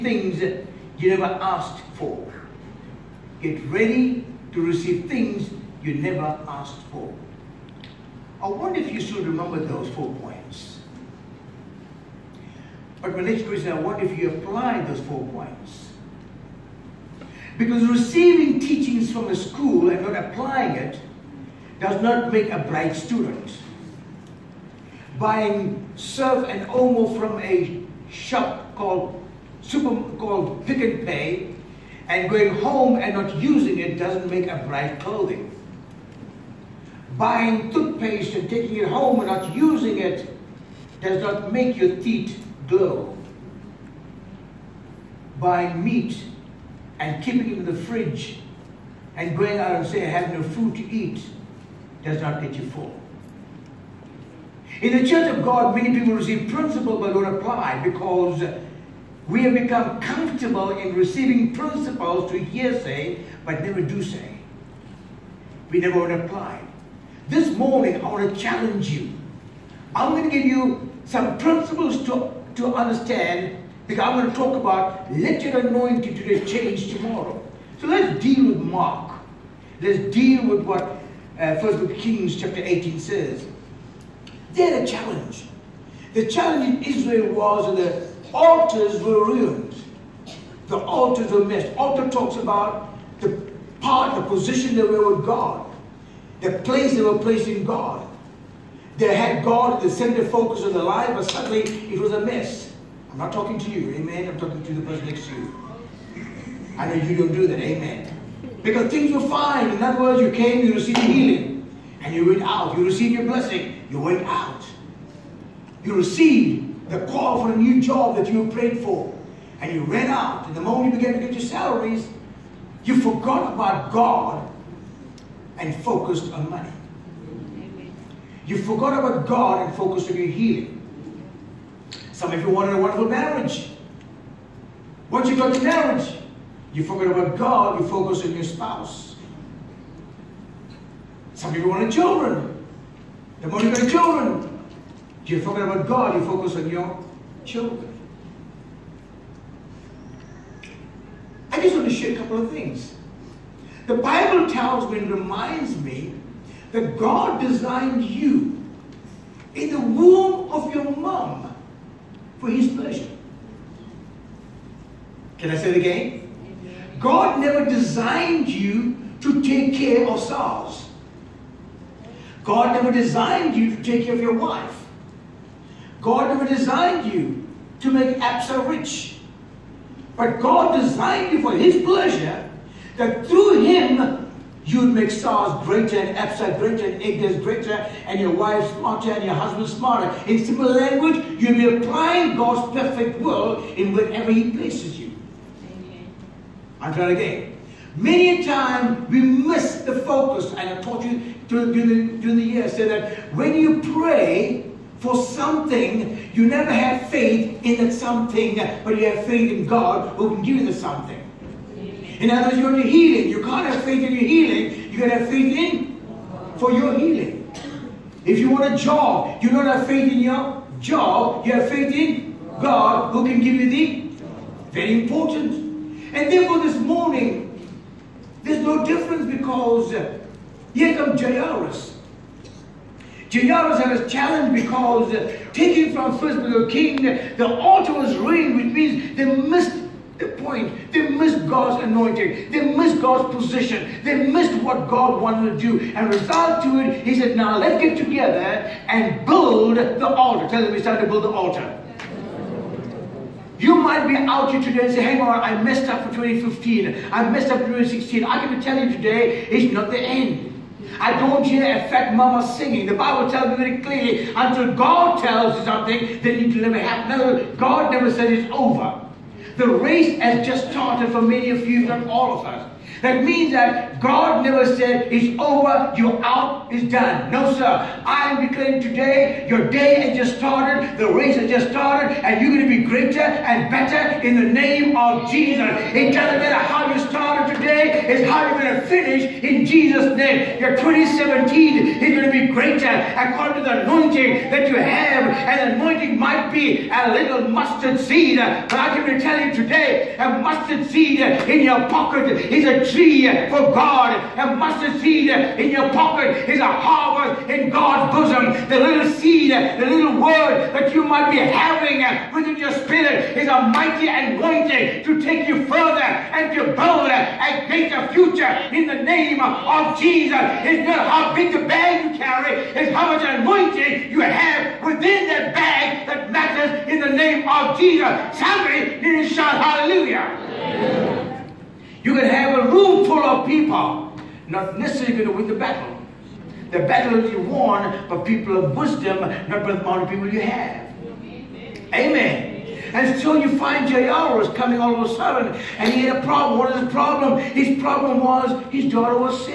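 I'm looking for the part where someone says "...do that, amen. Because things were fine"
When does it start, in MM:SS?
01:47.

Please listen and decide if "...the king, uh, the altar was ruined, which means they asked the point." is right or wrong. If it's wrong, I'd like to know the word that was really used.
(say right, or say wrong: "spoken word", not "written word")
wrong: "missed", not "asked".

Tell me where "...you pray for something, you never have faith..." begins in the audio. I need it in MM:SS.
03:23.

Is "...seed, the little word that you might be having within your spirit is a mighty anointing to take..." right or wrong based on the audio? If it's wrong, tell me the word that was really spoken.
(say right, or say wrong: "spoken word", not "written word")
right.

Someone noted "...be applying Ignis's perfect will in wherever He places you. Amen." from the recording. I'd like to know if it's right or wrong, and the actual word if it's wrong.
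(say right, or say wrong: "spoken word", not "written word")
wrong: "God", not "Ignis".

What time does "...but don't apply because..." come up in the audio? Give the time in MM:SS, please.
00:56.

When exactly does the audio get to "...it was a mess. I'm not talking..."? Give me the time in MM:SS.
01:41.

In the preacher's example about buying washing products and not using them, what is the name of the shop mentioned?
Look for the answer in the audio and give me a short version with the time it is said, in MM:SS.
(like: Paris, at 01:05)
Pick n Pay, at 00:30.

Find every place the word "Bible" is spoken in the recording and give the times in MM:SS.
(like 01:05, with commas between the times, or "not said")
02:33, 04:22.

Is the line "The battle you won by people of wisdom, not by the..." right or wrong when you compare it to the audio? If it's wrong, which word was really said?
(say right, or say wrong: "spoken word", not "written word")
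right.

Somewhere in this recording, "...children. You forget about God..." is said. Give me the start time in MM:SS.
02:23.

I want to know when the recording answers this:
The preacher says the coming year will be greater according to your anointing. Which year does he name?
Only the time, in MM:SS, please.
04:50.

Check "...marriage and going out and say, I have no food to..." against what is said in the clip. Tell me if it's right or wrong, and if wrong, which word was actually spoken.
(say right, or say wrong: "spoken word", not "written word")
wrong: "fridge", not "marriage".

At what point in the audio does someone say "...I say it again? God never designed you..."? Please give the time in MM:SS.
02:45.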